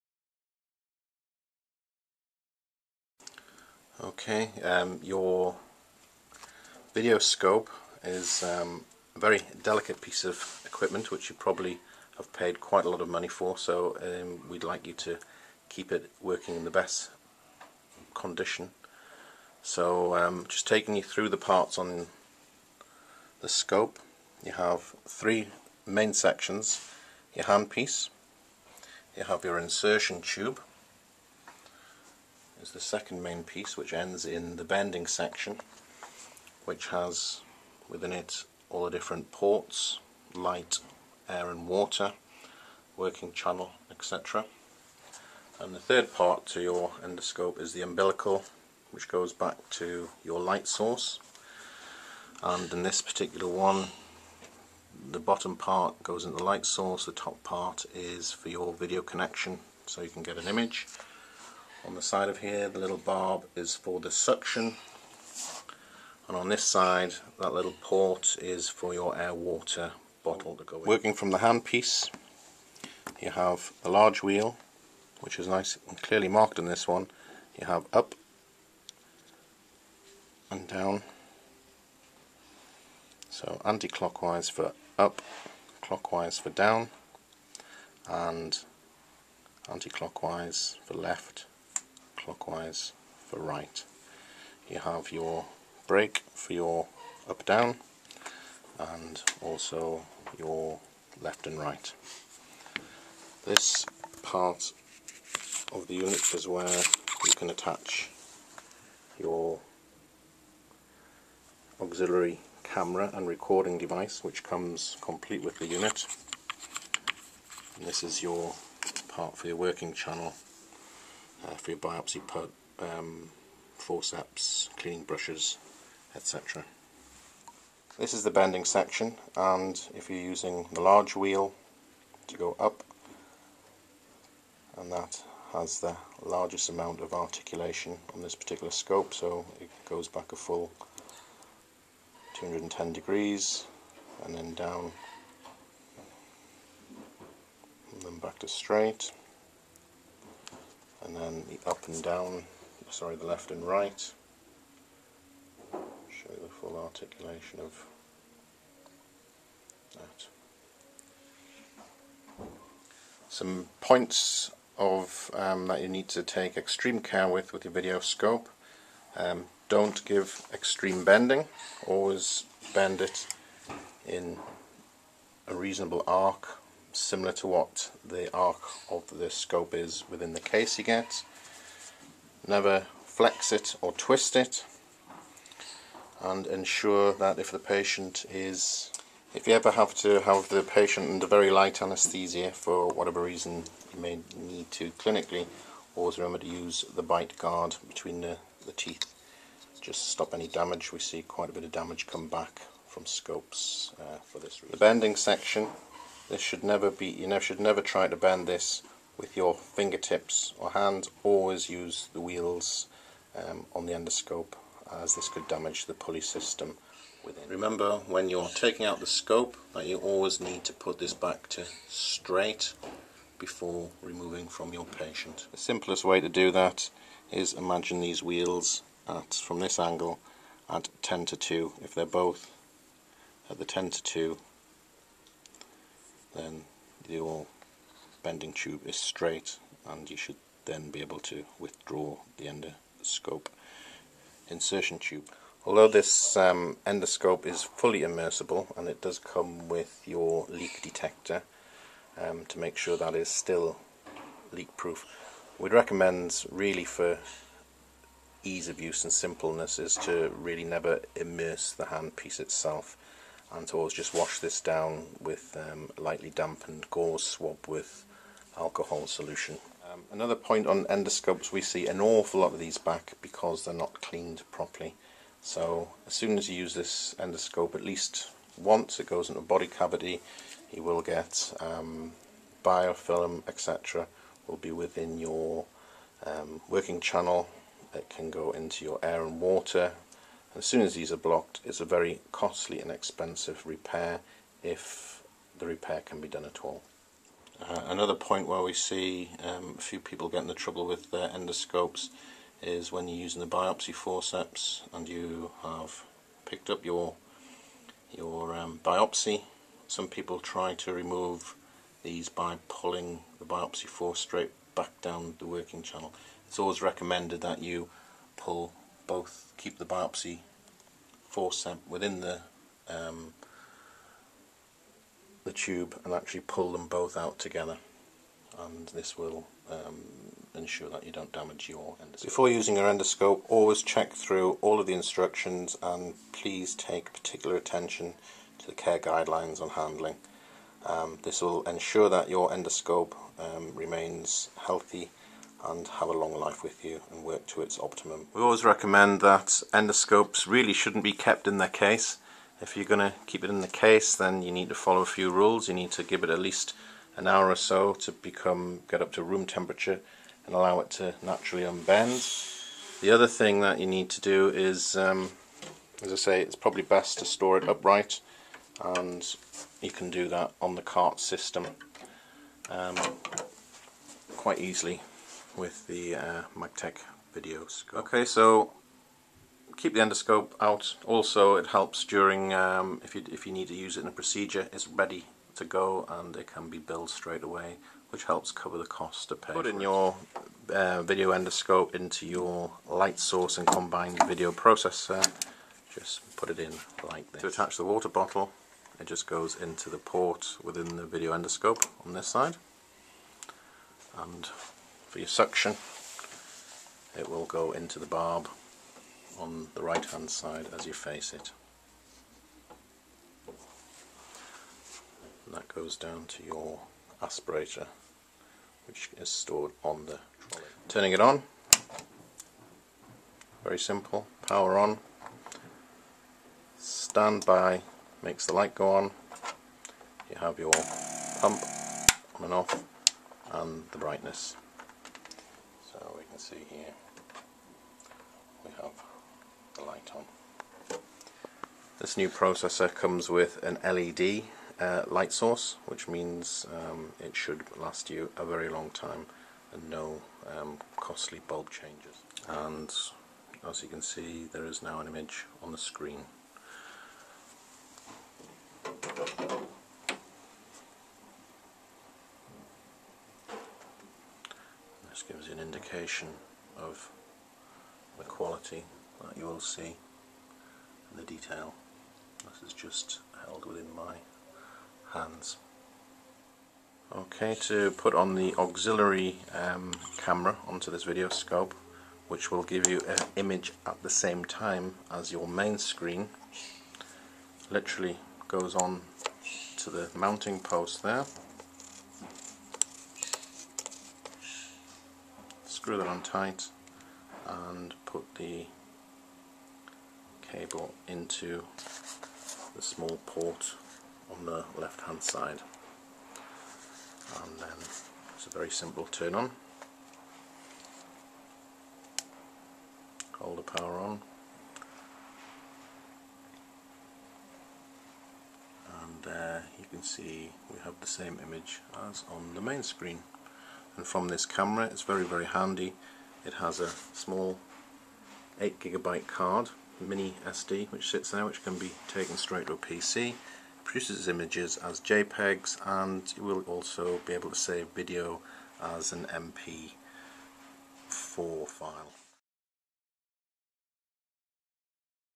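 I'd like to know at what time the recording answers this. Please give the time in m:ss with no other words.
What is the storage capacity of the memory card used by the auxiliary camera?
8:48.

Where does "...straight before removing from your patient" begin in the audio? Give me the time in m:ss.
3:41.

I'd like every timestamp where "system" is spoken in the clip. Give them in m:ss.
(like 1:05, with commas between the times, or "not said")
3:36, 6:11.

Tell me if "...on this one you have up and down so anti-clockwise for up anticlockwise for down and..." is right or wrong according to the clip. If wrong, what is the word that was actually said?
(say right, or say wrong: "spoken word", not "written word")
wrong: "clockwise", not "anticlockwise".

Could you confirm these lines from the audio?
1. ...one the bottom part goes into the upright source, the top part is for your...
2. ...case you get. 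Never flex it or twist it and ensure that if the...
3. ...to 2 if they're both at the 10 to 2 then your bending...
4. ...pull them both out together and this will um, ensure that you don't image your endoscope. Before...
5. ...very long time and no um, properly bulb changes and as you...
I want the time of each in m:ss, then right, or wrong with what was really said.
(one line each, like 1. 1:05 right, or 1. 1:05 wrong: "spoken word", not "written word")
1. 0:53 wrong: "light", not "upright"
2. 3:00 right
3. 3:51 right
4. 5:26 wrong: "damage", not "image"
5. 7:28 wrong: "costly", not "properly".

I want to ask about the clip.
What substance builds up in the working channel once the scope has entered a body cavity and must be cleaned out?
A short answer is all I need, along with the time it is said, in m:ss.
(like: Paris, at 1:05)
biofilm, at 4:42.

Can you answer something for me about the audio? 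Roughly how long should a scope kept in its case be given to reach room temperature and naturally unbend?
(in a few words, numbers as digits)
an hour.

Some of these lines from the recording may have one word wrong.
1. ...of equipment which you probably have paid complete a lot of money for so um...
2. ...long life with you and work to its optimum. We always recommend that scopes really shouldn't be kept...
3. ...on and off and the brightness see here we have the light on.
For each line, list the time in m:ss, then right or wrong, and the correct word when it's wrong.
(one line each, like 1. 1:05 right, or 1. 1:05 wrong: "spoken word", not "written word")
1. 0:10 wrong: "quite", not "complete"
2. 5:46 wrong: "endoscopes", not "scopes"
3. 7:12 right.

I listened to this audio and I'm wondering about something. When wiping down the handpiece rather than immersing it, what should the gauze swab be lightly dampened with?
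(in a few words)
alcohol solution.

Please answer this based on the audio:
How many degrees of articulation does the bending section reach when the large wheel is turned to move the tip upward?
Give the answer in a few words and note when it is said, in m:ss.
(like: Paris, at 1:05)
210 degrees, at 2:22.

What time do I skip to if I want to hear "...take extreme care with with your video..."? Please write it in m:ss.
2:46.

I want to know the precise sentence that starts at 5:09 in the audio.
Some people try to remove these by pulling the biopsy force straight back down the working channel.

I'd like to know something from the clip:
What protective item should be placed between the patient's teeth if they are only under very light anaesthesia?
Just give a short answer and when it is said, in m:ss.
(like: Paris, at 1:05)
bite guard, at 3:17.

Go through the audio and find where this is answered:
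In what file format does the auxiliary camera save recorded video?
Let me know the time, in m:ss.
8:59.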